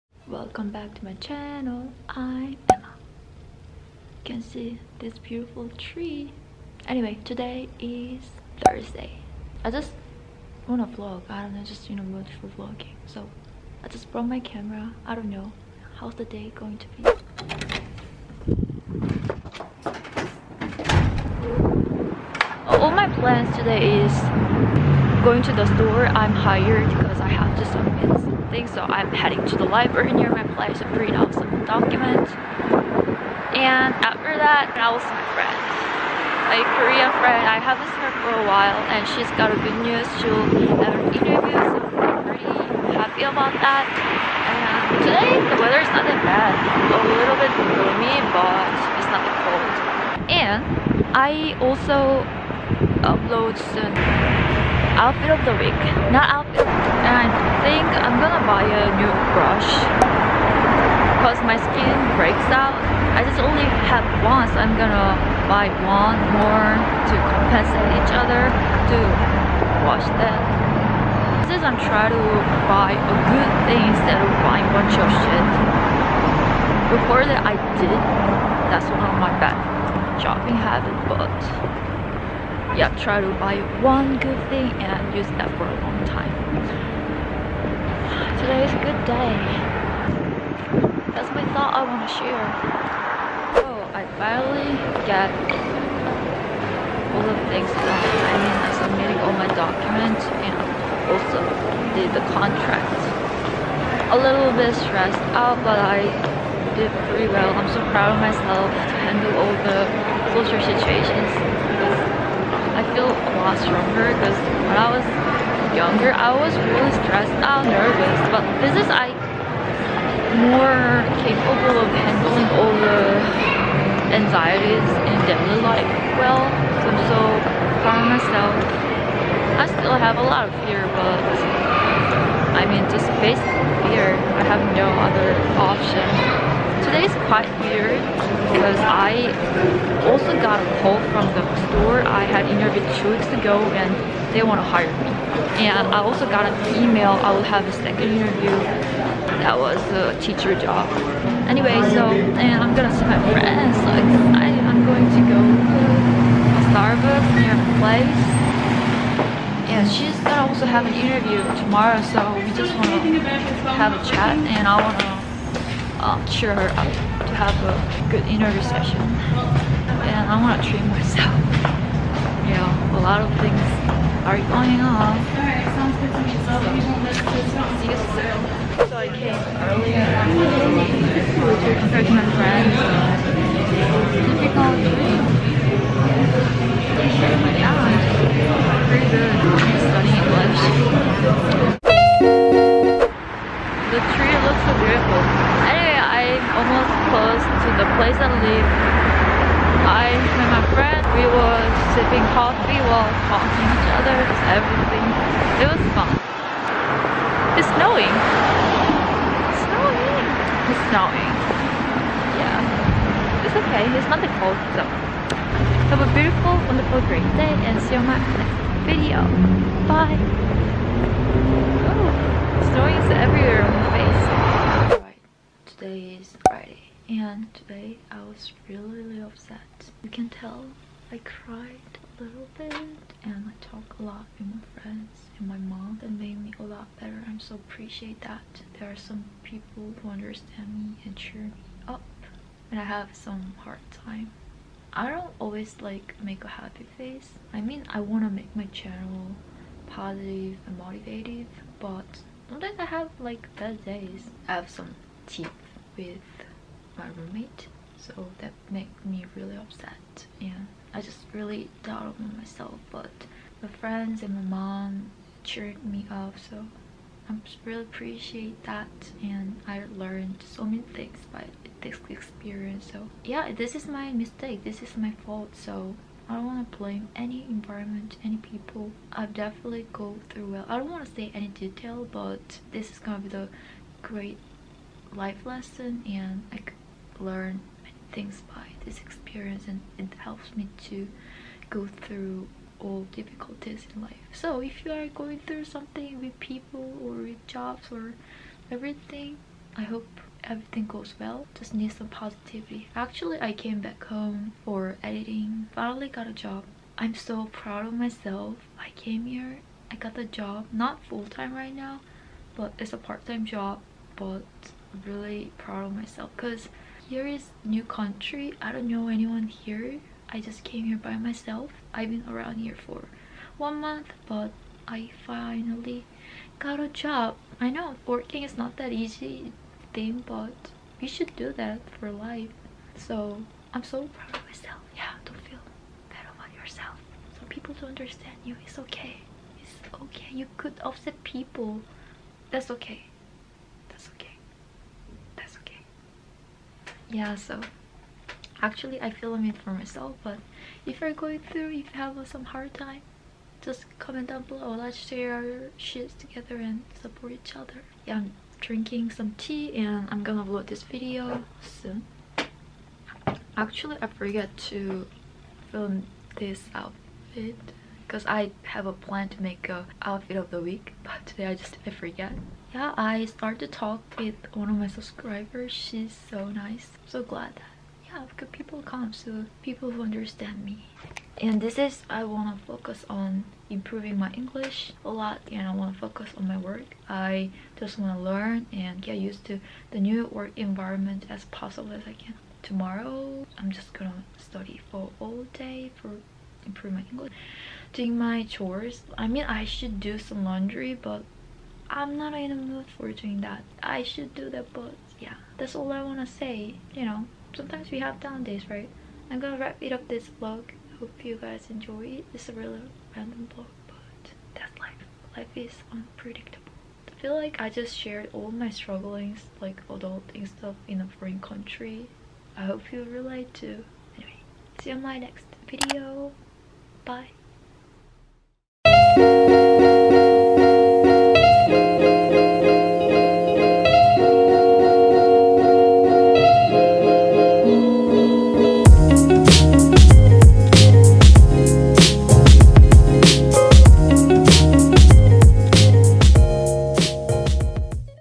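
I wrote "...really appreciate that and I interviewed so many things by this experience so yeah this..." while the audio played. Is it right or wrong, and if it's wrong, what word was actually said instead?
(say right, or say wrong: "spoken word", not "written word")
wrong: "learned", not "interviewed".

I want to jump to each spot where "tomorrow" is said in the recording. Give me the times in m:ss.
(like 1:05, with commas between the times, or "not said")
2:41, 6:32.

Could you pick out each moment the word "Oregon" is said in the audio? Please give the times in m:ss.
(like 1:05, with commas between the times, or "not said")
not said.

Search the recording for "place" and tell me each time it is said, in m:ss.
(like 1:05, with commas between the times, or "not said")
0:30, 2:37, 3:17.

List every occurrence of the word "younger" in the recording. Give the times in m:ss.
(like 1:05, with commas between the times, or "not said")
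1:55.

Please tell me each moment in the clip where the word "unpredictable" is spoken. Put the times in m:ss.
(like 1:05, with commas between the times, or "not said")
6:55.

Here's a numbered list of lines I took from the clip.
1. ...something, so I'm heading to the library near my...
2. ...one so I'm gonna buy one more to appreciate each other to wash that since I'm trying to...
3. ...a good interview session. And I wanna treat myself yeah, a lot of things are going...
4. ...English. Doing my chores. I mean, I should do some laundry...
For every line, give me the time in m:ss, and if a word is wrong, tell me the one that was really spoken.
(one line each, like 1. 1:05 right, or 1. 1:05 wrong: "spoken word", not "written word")
1. 0:28 right
2. 1:04 wrong: "compensate", not "appreciate"
3. 2:47 right
4. 6:37 right.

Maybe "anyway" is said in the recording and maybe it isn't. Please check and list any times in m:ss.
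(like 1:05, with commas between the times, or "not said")
0:06, 2:31, 3:15, 7:04.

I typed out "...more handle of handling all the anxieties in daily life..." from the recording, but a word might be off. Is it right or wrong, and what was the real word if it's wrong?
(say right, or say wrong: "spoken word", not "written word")
wrong: "capable", not "handle".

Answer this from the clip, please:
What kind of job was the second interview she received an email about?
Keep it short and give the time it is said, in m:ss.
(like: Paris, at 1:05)
Teacher, at 2:30.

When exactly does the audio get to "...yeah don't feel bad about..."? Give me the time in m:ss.
5:34.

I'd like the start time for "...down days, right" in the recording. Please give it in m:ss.
6:48.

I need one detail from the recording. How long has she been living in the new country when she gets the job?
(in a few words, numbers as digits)
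One month.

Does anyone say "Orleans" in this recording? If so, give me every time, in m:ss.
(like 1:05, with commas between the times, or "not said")
not said.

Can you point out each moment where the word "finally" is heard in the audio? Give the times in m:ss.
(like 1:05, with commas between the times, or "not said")
1:34, 5:05, 5:25.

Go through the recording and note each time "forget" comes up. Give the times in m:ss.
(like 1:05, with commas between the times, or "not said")
6:04, 6:11.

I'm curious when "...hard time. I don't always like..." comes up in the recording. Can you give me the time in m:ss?
4:03.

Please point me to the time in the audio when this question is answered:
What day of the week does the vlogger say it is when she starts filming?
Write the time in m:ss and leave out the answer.
0:07.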